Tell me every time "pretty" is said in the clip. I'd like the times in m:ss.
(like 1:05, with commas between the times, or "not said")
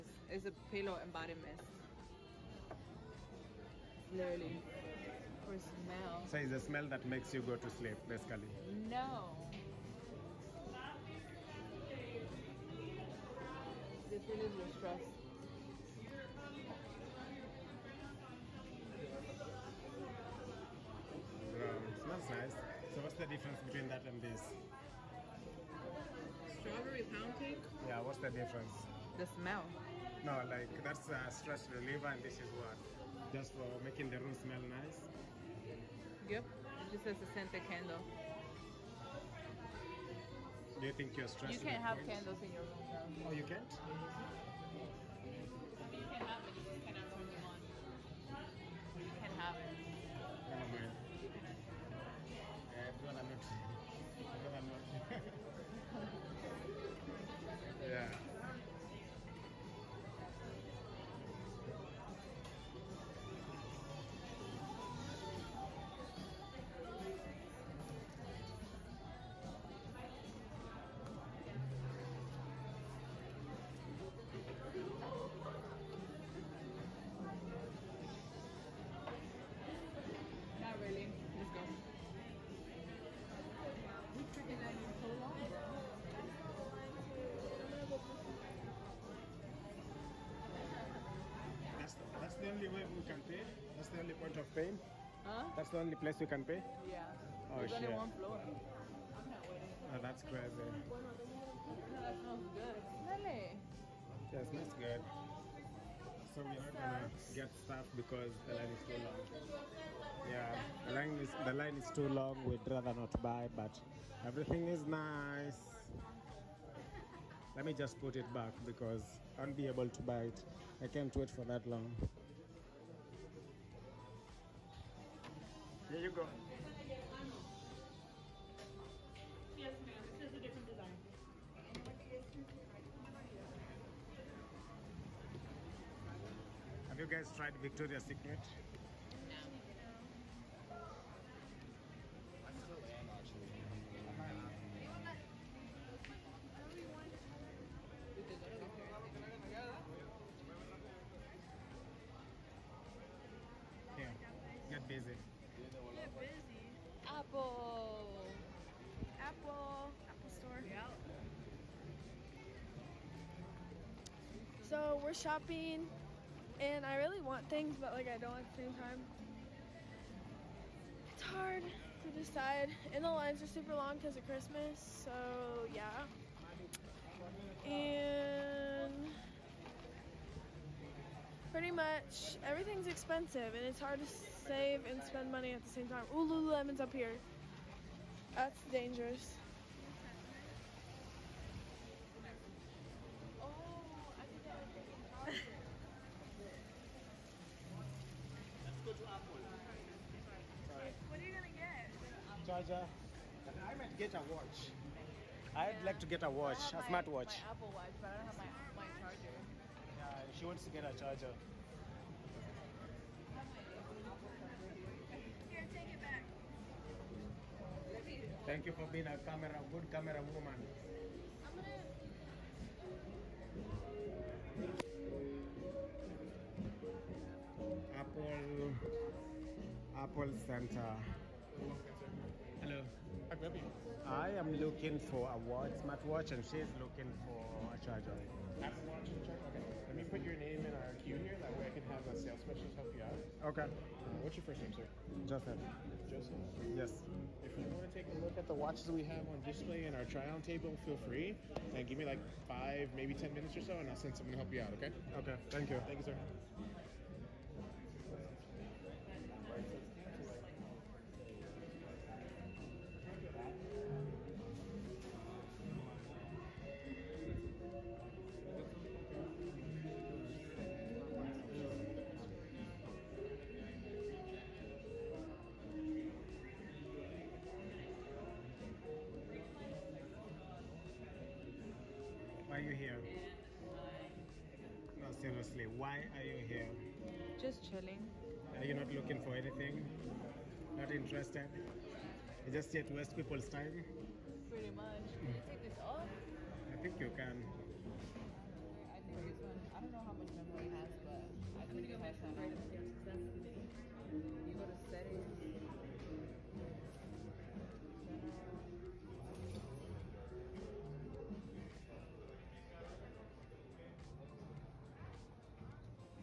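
3:01, 4:54.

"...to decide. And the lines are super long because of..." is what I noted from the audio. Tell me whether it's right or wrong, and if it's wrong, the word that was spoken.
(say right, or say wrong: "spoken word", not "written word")
right.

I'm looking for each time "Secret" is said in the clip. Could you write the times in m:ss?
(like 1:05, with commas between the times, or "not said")
2:18.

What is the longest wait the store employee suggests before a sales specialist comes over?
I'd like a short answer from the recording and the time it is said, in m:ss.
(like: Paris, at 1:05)
10 minutes, at 4:13.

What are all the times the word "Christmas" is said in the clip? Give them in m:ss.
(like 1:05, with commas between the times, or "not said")
2:54.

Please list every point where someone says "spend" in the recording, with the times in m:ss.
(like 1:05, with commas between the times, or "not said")
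3:05.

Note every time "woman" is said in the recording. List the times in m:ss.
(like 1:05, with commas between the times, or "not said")
3:40.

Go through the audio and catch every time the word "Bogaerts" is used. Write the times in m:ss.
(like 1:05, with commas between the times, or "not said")
not said.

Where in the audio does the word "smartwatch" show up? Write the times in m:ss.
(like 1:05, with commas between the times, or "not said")
3:26, 3:55.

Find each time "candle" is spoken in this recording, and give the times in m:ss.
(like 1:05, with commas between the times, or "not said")
0:37, 0:42.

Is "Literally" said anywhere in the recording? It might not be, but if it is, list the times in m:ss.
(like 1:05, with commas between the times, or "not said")
0:04.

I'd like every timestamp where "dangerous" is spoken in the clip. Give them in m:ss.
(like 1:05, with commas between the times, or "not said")
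3:08.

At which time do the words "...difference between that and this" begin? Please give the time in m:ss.
0:23.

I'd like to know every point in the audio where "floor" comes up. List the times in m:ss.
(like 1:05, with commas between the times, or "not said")
1:38.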